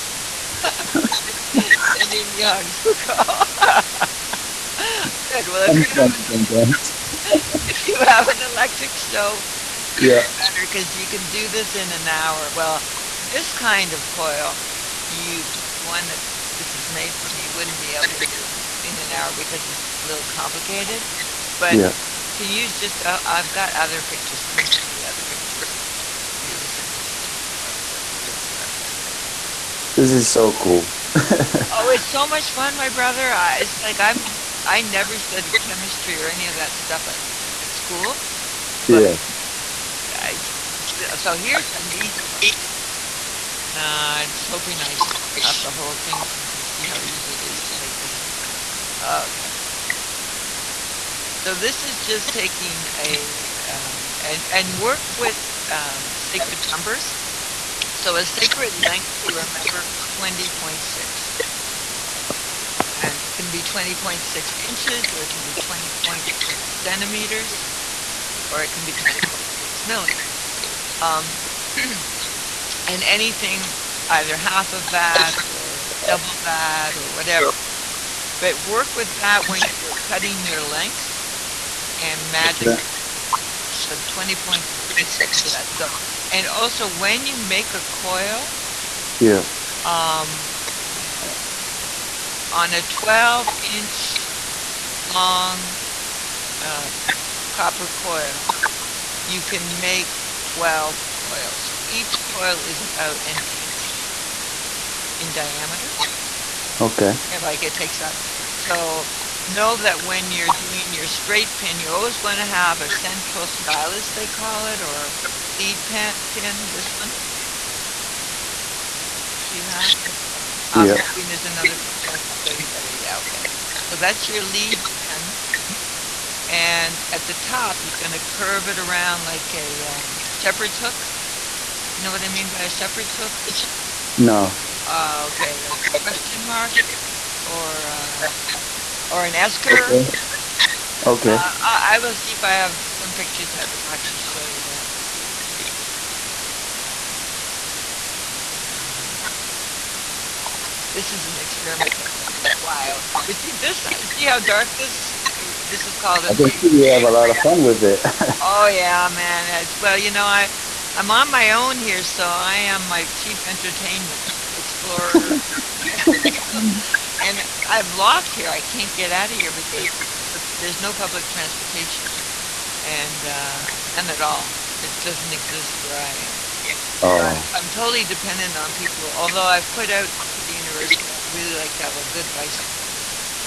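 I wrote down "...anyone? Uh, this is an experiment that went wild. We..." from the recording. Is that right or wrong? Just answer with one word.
right.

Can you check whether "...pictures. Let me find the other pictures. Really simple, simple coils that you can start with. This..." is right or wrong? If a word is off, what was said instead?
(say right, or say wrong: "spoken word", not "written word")
right.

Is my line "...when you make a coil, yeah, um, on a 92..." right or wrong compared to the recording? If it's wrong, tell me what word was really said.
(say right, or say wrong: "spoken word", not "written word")
wrong: "12", not "92".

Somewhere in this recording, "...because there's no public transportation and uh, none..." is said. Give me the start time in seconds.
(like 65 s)
169 s.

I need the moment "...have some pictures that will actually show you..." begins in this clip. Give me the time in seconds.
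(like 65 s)
142 s.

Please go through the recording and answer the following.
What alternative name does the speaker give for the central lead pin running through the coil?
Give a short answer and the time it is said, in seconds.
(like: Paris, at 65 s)
stylus, at 113 s.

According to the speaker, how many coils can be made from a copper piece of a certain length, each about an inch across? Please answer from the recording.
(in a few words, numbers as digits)
12.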